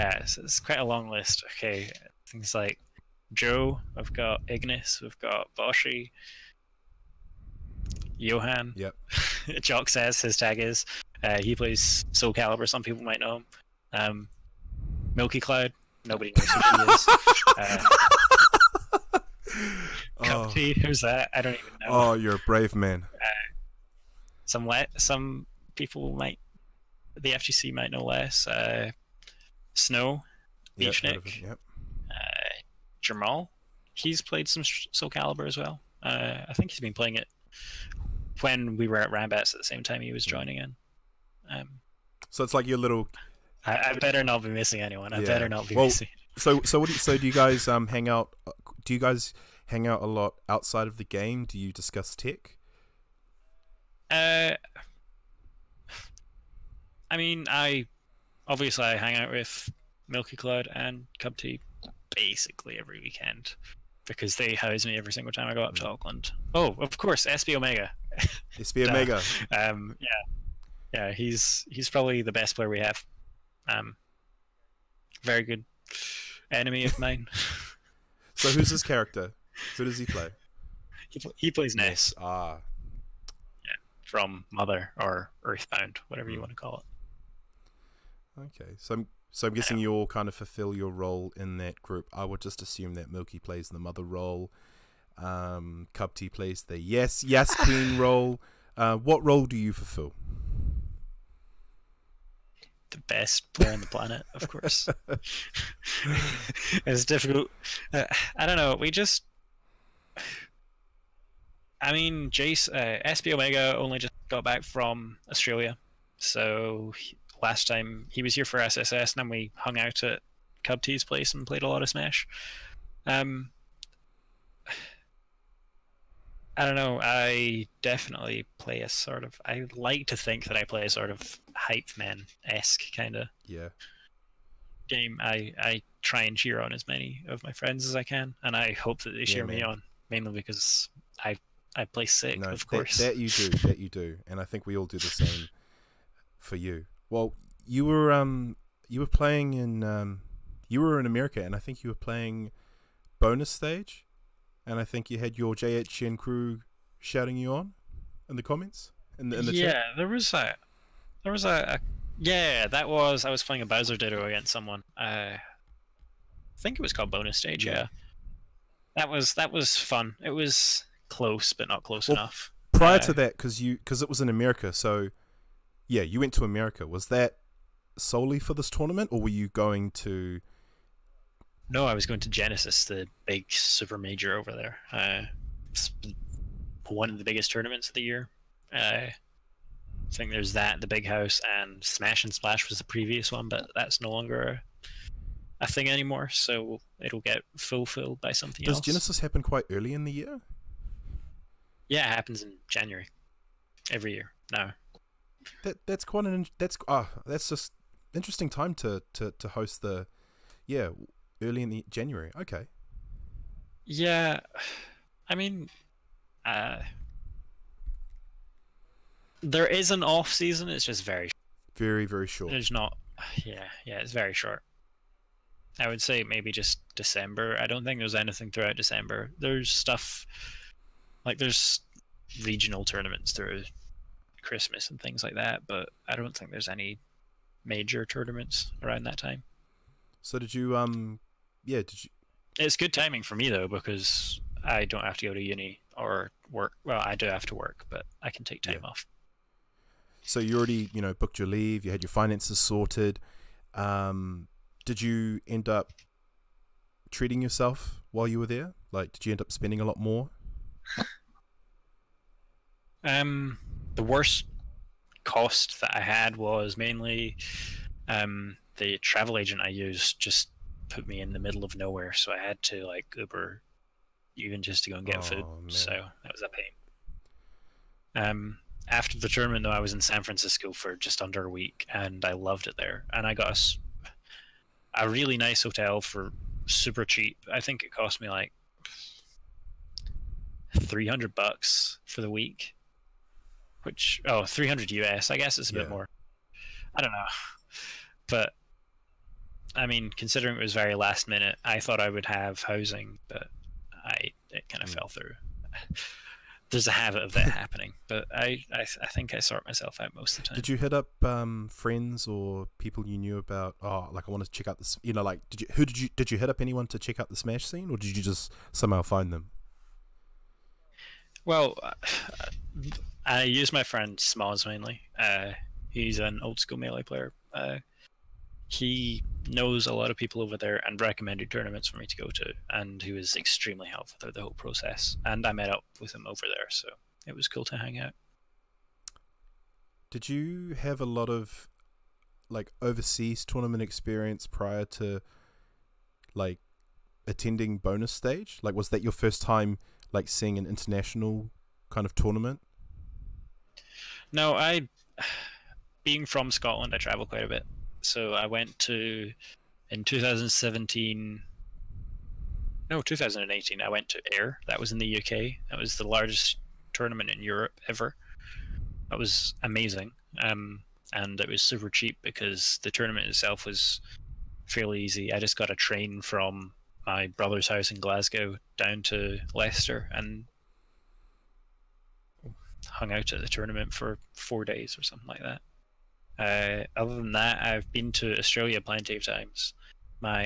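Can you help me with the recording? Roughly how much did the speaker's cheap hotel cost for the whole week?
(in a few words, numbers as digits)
300 US.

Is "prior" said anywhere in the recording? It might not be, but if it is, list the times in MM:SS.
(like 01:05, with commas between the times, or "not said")
02:52, 05:44.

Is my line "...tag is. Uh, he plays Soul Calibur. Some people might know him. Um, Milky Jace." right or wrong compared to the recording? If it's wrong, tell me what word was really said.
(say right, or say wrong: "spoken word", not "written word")
wrong: "Cloud", not "Jace".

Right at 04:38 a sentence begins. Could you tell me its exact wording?
Um, after the tournament, though, I was in San Francisco for just under a week, and I loved it there.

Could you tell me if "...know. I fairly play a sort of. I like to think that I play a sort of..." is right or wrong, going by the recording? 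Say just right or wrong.
wrong.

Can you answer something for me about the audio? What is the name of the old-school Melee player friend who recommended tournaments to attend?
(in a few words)
Smalls.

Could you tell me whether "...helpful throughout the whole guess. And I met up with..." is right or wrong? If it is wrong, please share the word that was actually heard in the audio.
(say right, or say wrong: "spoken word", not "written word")
wrong: "process", not "guess".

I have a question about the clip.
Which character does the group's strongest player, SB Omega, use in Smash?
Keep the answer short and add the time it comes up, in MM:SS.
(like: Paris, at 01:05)
Ness, at 01:21.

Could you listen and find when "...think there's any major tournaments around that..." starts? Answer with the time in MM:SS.
03:56.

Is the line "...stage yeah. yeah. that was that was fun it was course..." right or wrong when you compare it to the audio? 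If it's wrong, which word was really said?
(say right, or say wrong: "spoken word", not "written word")
wrong: "close", not "course".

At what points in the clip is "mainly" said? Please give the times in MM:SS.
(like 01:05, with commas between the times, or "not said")
02:20, 04:26, 05:24.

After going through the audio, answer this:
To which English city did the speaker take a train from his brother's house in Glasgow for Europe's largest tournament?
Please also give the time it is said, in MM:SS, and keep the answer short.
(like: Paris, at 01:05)
Leicester, at 06:19.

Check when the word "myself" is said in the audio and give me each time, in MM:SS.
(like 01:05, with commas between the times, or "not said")
05:09.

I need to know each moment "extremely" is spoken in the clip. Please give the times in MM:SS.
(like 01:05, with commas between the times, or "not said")
05:33.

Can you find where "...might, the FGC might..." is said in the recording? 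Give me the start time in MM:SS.
00:26.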